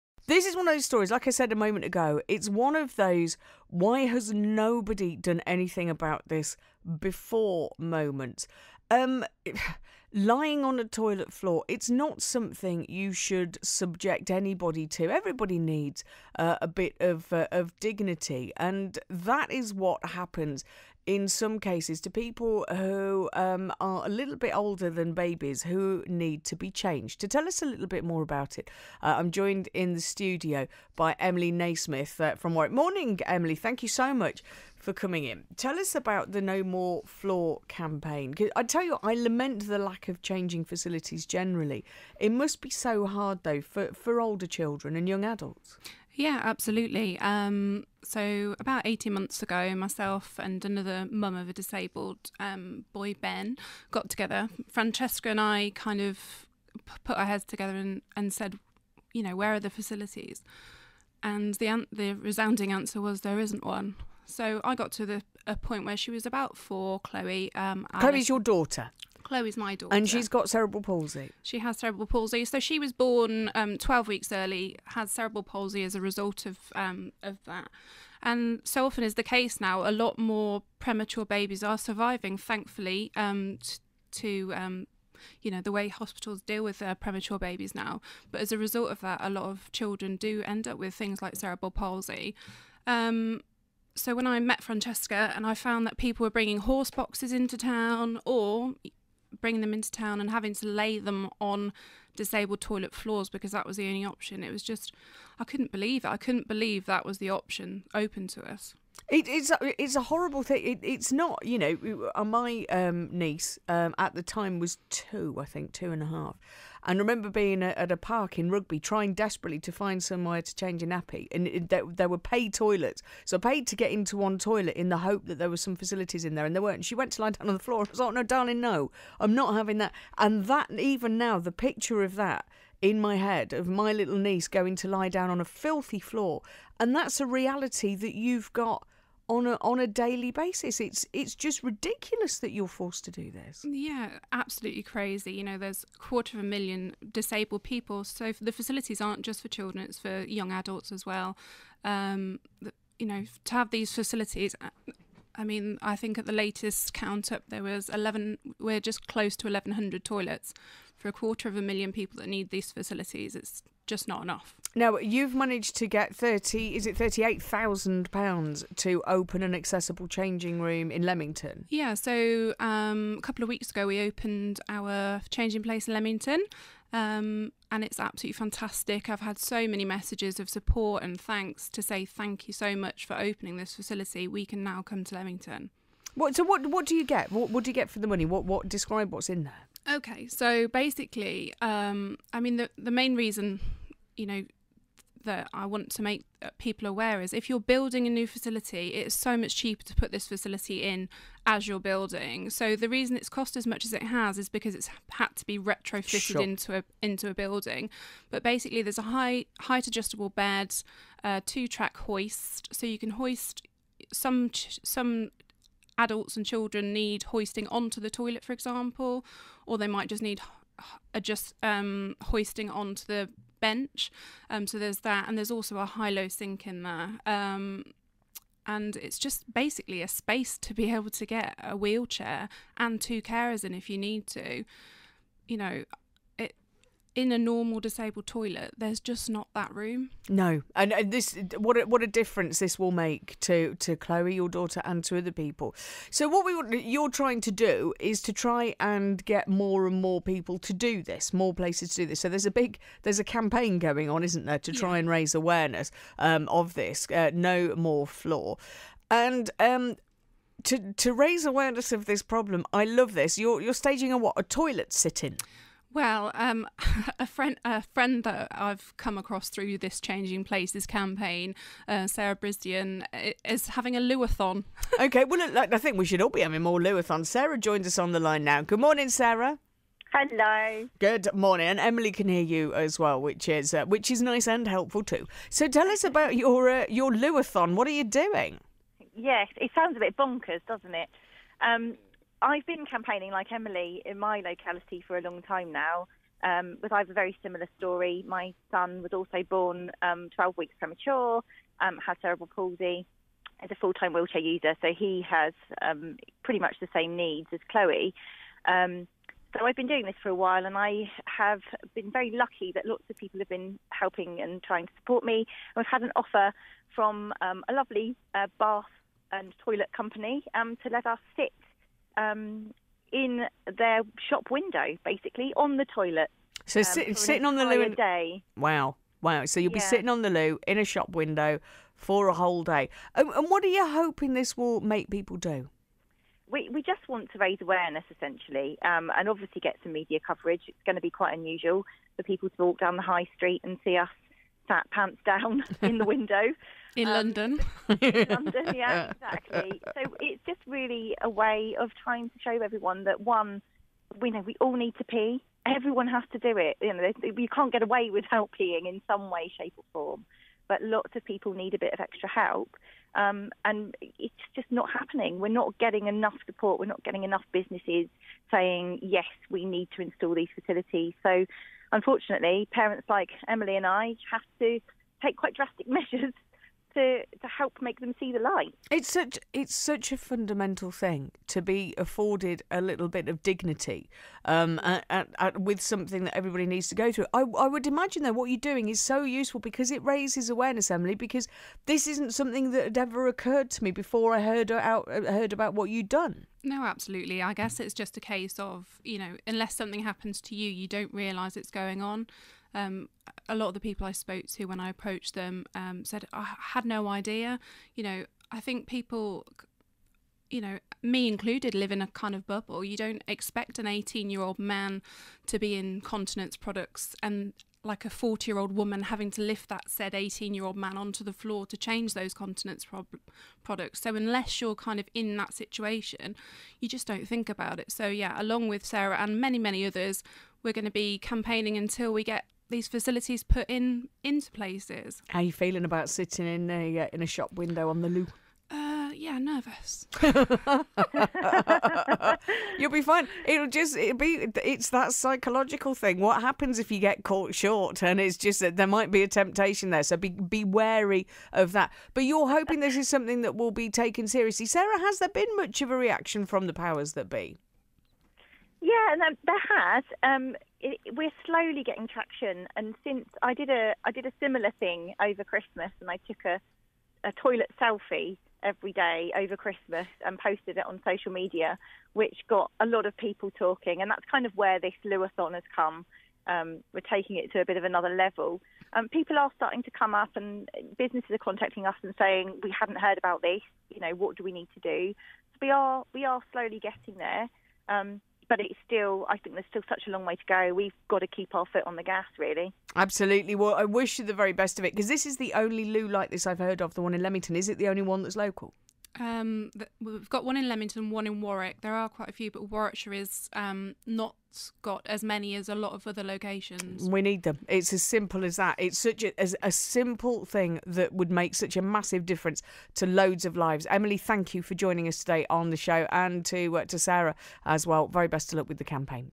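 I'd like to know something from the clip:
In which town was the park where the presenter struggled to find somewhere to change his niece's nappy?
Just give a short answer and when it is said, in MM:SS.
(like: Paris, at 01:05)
Rugby, at 01:58.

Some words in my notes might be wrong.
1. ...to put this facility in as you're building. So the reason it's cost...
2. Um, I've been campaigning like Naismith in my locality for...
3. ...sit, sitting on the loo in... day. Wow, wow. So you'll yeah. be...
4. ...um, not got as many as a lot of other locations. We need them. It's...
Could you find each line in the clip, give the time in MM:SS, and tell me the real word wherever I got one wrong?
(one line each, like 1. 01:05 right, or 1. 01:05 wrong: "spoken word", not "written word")
1. 03:19 right
2. 04:51 wrong: "Emily", not "Naismith"
3. 05:26 right
4. 08:23 right.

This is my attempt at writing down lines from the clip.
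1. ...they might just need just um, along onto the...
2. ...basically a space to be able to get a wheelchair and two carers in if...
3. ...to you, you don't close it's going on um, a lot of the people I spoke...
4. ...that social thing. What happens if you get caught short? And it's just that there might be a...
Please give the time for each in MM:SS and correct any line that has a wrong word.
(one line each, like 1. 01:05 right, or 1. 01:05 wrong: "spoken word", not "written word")
1. 03:39 wrong: "hoisting", not "along"
2. 03:49 right
3. 06:40 wrong: "realise", not "close"
4. 07:24 wrong: "psychological", not "social".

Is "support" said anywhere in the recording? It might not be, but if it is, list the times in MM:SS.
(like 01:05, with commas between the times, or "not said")
03:00, 05:14, 06:06.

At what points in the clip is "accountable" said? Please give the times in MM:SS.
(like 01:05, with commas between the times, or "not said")
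not said.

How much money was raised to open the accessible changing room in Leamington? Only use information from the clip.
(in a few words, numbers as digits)
£38,000.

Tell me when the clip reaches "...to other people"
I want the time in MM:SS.
04:05.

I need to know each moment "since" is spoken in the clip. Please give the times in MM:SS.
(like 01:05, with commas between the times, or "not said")
07:43.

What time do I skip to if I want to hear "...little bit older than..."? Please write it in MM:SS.
00:24.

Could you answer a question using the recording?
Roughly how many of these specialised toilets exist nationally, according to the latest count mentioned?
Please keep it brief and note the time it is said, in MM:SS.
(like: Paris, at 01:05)
1,100, at 02:39.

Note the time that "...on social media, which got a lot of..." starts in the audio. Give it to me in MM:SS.
07:50.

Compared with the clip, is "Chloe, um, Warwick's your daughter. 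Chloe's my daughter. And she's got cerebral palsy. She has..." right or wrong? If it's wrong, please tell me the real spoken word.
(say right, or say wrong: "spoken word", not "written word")
wrong: "Chloe", not "Warwick".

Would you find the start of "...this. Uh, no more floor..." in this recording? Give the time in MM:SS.
04:16.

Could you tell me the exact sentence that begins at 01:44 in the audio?
It was just, I couldn't believe it.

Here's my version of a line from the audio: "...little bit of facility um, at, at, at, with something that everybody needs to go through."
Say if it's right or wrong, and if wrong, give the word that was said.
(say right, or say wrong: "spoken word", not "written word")
wrong: "dignity", not "facility".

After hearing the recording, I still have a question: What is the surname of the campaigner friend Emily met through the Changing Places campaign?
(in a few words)
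Brisdion.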